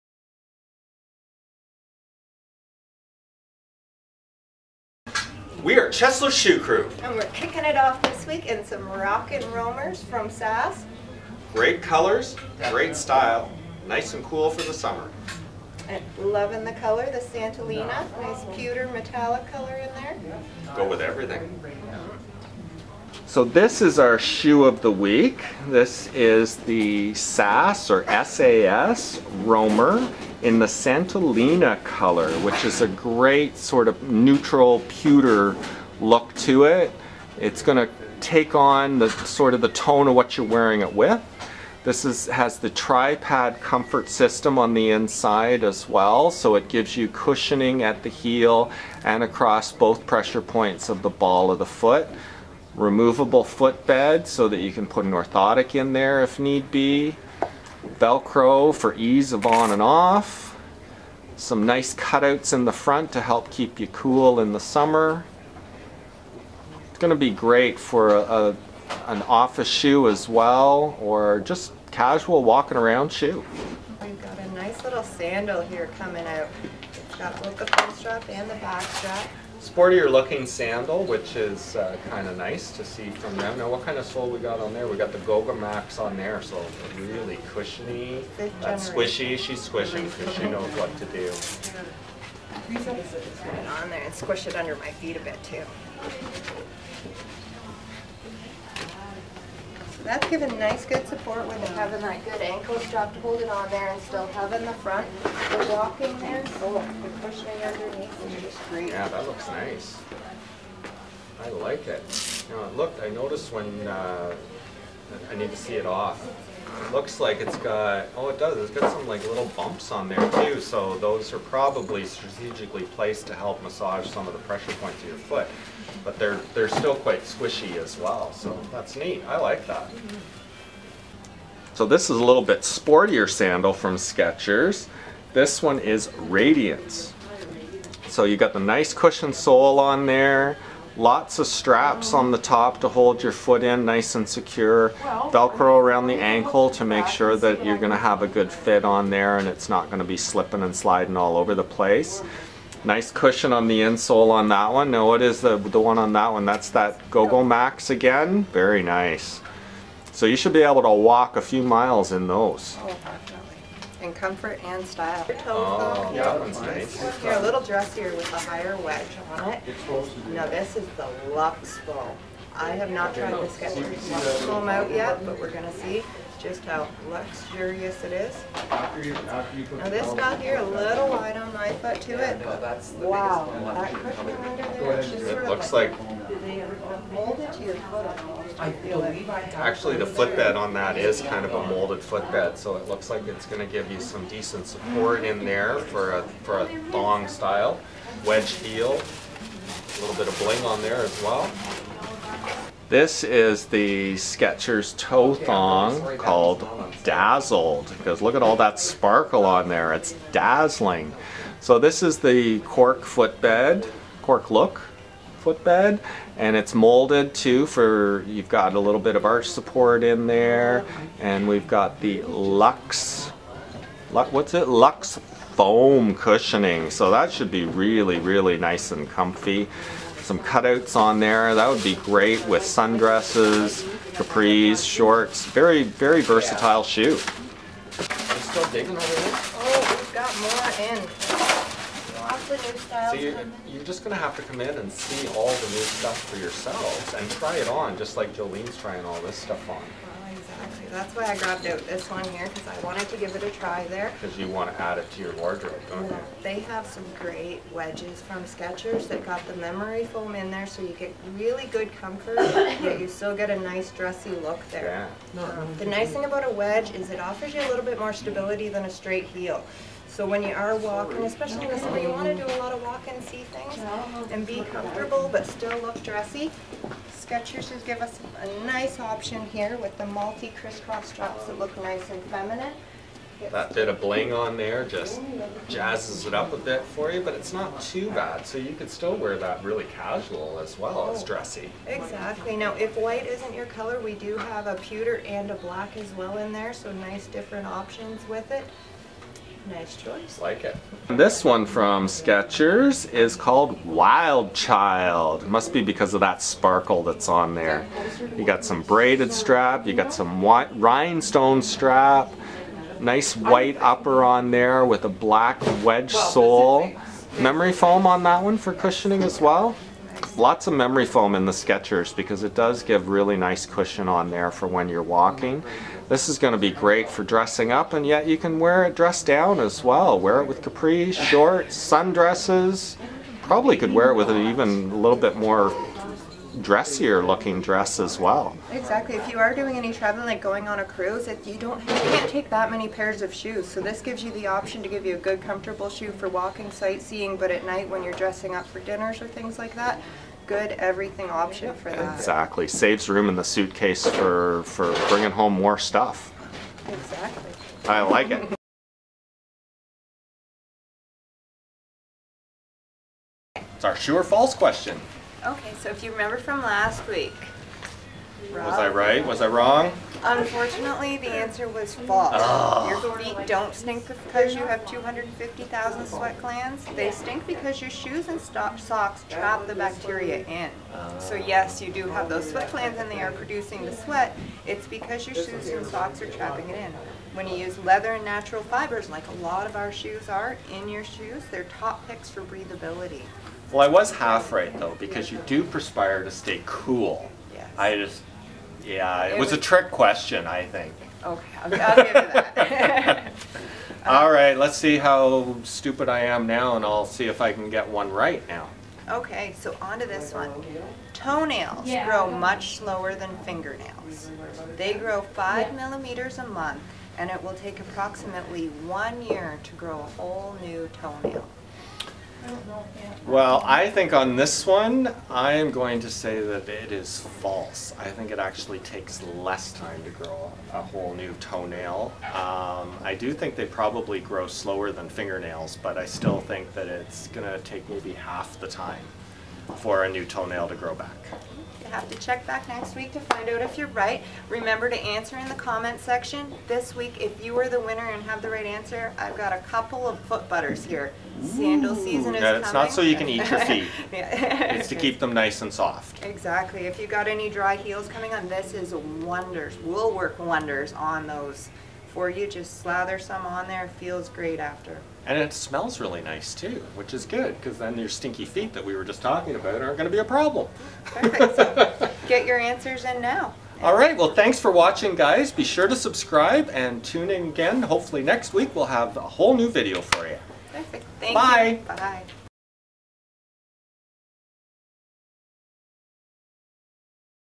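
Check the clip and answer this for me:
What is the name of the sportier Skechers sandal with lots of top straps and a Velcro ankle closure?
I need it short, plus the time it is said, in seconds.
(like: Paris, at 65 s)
Radiance, at 136 s.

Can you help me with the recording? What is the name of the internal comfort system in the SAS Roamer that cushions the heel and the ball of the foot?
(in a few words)
tripod comfort system.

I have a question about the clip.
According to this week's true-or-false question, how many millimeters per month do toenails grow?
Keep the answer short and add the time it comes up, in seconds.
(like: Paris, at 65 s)
5, at 415 s.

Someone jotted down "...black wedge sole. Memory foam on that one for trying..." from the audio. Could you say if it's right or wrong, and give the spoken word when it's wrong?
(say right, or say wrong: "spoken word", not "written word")
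wrong: "cushioning", not "trying".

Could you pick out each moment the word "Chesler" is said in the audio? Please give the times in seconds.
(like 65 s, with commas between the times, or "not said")
5 s.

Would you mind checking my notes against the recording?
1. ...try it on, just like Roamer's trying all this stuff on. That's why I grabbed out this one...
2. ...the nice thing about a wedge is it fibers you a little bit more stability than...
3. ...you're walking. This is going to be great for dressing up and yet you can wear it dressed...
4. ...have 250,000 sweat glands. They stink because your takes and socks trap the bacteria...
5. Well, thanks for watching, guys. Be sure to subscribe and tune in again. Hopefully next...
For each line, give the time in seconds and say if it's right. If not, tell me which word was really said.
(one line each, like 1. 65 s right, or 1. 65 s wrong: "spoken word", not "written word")
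1. 247 s wrong: "Jolene", not "Roamer"
2. 265 s wrong: "offers", not "fibers"
3. 324 s right
4. 374 s wrong: "shoes", not "takes"
5. 474 s right.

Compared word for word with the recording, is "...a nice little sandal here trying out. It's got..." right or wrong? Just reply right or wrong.
wrong.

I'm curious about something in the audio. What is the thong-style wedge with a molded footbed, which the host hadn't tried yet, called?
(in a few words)
Lux Bowl.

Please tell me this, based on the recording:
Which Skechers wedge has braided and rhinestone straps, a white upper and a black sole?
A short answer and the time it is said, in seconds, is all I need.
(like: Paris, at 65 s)
Wild Child, at 303 s.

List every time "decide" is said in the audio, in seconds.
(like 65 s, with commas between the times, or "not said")
not said.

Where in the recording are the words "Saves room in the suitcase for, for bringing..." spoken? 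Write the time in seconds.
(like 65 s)
352 s.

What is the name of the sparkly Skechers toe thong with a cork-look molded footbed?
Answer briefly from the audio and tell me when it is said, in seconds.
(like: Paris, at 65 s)
Dazzled, at 207 s.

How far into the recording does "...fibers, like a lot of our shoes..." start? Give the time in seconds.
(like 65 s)
388 s.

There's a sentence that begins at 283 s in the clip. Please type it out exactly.
That bit of bling on there just jazzes it up a bit for you, but it's not too bad.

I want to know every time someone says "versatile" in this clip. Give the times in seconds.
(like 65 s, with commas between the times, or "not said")
236 s.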